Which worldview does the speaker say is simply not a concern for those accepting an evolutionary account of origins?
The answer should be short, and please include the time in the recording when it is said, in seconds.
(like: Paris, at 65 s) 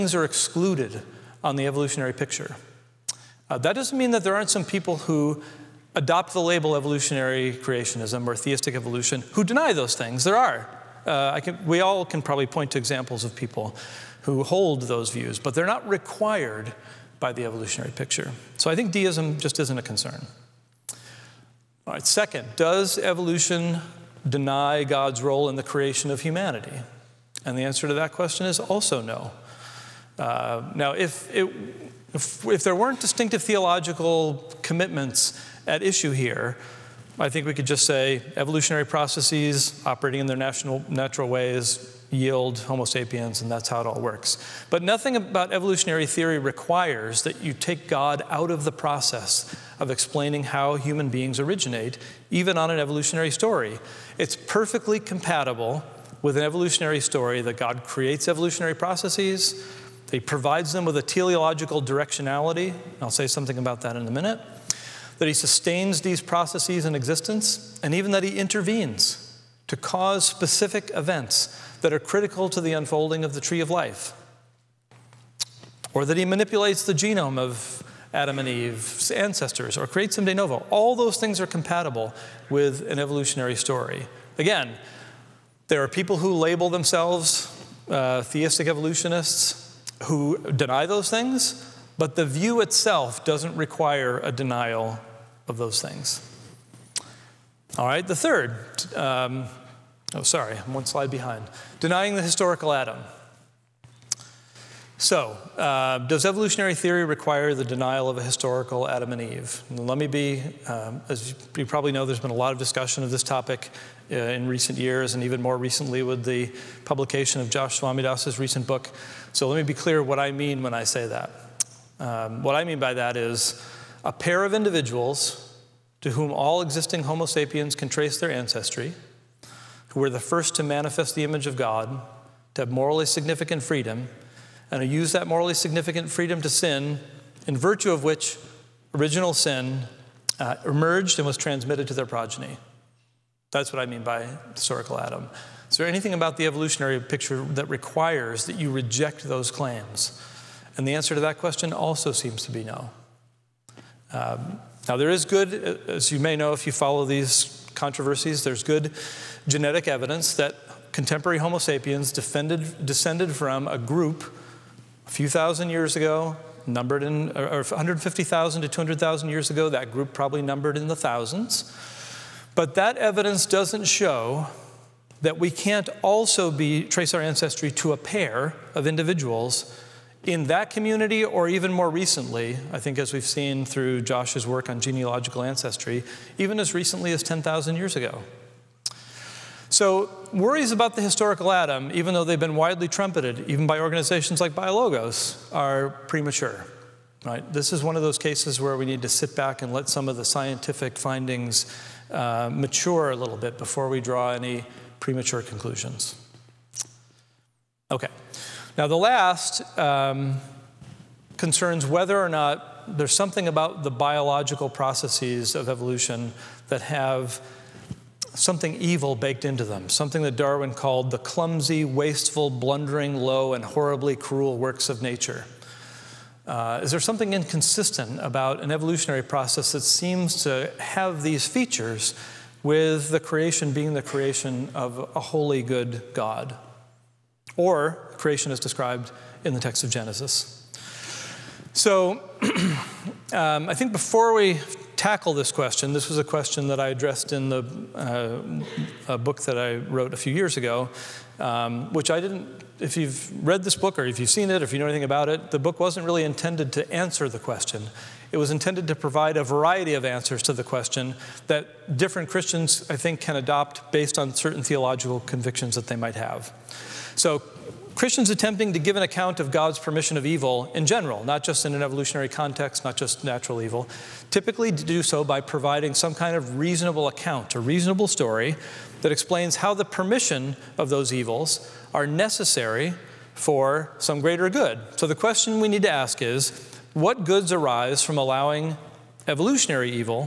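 Deism, at 18 s.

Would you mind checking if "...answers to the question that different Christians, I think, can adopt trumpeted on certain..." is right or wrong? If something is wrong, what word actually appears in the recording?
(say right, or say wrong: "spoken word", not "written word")
wrong: "based", not "trumpeted".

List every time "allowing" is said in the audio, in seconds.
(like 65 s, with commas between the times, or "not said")
288 s.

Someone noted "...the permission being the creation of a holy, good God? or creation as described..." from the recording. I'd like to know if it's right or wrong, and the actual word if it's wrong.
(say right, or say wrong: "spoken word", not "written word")
wrong: "creation", not "permission".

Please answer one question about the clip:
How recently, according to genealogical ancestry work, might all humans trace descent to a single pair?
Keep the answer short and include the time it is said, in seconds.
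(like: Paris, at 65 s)
10,000 years ago, at 187 s.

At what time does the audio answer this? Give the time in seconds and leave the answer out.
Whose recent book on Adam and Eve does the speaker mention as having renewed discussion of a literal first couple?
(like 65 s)
117 s.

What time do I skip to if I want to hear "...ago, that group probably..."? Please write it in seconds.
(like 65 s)
169 s.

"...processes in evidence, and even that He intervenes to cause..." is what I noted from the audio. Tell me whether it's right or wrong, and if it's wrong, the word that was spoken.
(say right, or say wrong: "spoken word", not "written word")
wrong: "existence", not "evidence".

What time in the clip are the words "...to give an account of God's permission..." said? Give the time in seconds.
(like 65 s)
268 s.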